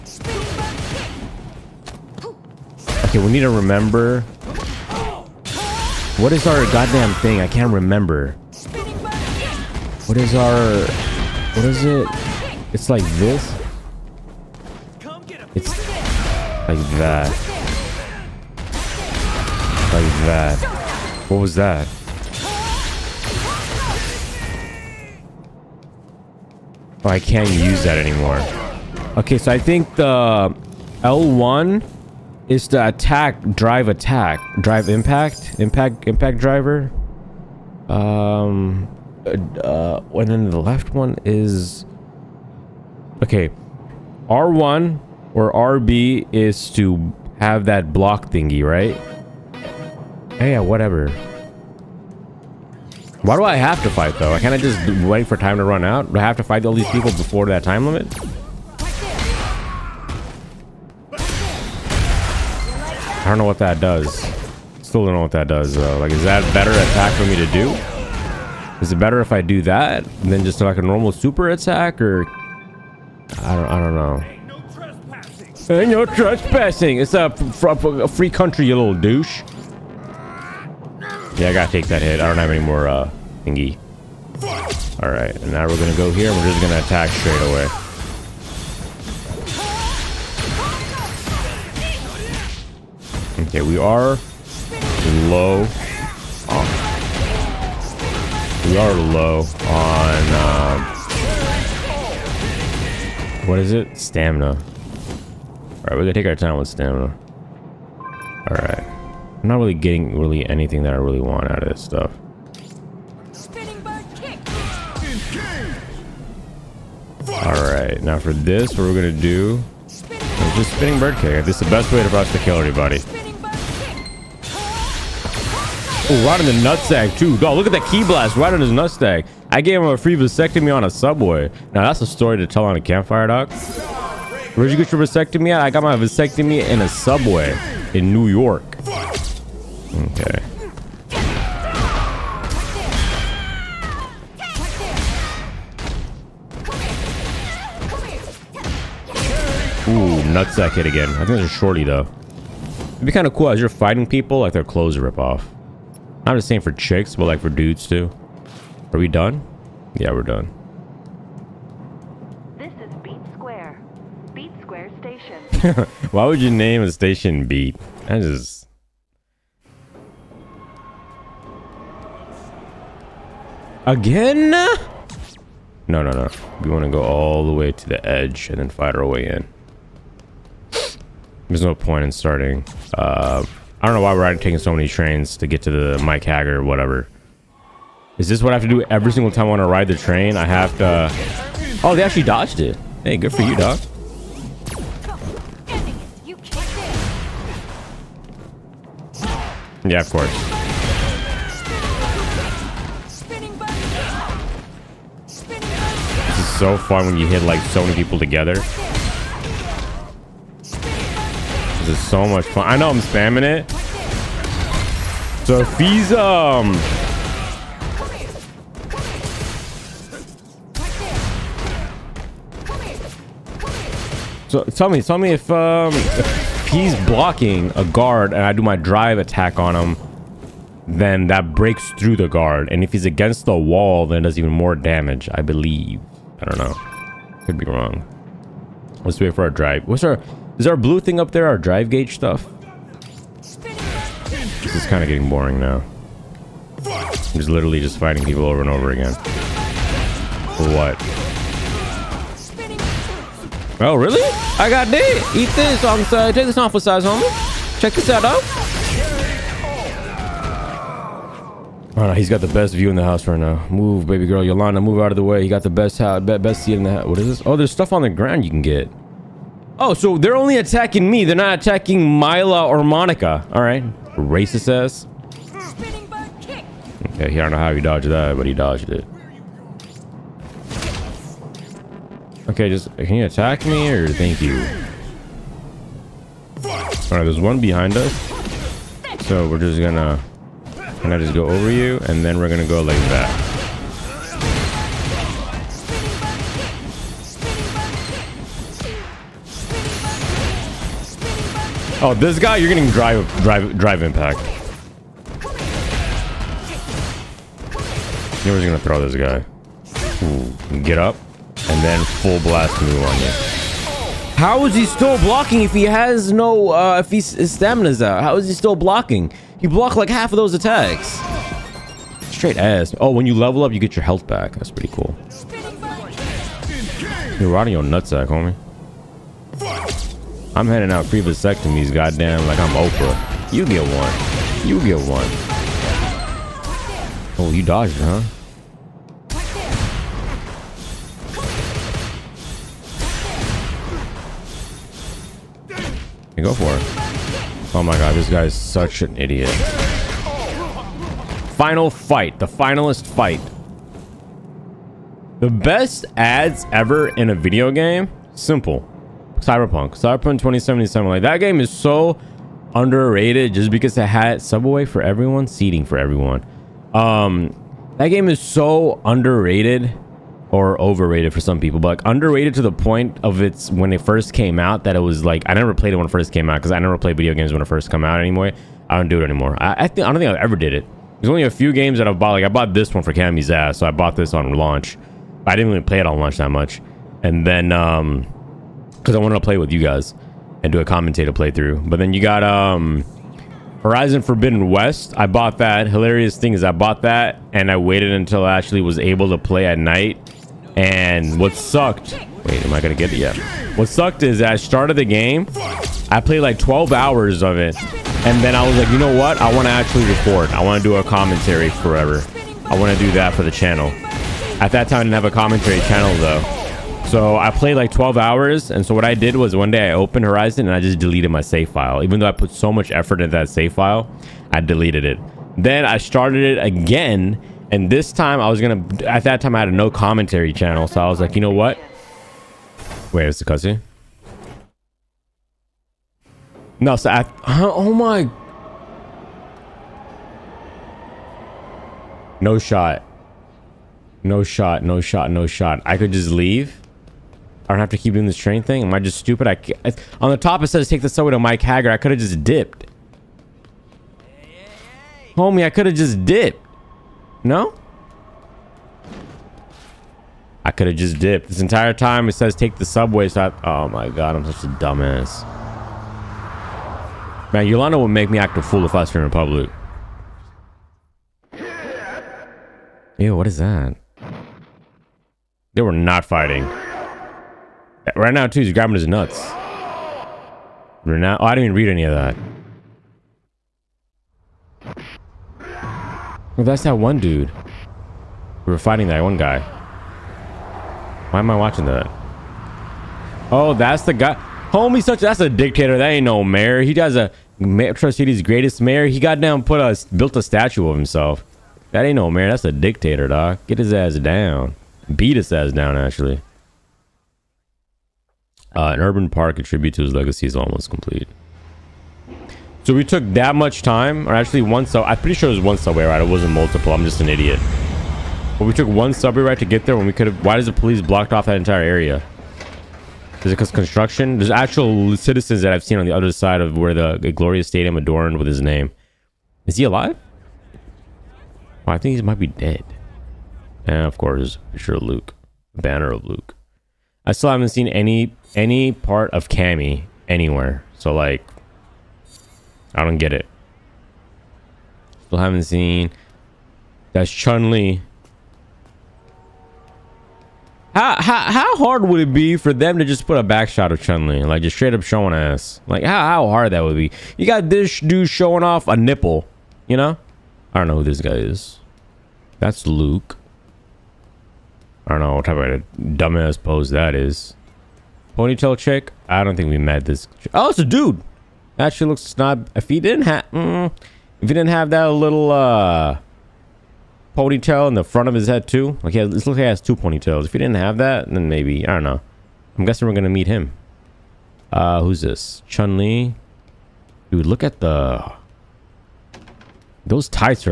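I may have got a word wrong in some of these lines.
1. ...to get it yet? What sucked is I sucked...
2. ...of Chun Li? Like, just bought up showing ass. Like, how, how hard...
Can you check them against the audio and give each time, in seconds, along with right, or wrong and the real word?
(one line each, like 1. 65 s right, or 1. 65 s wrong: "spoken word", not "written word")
1. 402 s wrong: "started", not "sucked"
2. 553 s wrong: "straight", not "bought".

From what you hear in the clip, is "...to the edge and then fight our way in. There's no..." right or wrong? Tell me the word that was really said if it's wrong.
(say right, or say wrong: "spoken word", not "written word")
right.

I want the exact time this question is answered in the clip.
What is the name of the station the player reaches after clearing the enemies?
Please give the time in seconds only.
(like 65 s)
164 s.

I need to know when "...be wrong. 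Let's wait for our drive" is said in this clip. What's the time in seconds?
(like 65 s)
237 s.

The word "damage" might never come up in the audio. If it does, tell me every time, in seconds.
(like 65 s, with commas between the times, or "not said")
234 s.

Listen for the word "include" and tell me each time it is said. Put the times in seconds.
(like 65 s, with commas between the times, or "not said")
not said.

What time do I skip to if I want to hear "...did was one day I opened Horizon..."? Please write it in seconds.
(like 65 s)
419 s.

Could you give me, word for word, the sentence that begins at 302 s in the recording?
Oh, this guy, you're getting drive, drive, drive impact.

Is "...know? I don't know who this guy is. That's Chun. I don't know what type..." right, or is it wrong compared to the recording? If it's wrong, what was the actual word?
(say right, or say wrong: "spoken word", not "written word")
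wrong: "Luke", not "Chun".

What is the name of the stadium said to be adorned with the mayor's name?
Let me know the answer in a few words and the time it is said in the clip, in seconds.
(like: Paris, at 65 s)
Gloria Stadium, at 527 s.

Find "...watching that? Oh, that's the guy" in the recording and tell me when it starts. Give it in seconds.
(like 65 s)
491 s.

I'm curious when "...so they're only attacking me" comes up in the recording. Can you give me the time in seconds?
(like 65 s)
269 s.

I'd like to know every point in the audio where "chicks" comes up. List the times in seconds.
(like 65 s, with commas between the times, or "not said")
156 s, 568 s.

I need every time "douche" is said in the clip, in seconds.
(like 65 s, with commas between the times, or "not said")
78 s.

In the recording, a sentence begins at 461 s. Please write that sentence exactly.
This entire time it says take the subway, so I, oh my god, I'm such a dumbass.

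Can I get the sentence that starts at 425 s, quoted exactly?
Then I started it again and this time I was going to, at that time I had a no commentary channel.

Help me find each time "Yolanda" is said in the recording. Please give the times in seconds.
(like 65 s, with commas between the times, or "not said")
264 s, 467 s.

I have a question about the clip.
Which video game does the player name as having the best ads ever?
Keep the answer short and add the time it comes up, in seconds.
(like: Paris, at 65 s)
Cyberpunk 2077, at 359 s.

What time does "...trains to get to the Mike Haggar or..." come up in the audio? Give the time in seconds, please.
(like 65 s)
184 s.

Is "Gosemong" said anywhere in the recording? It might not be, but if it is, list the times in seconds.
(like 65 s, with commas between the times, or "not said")
not said.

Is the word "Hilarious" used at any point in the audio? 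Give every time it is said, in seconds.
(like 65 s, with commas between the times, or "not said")
395 s.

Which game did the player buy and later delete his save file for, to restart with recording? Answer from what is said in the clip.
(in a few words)
Horizon Forbidden West.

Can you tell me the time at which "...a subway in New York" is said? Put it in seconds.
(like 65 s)
136 s.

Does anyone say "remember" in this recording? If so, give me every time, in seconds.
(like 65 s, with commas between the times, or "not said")
3 s, 7 s.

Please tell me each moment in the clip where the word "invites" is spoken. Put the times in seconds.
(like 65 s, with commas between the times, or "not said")
not said.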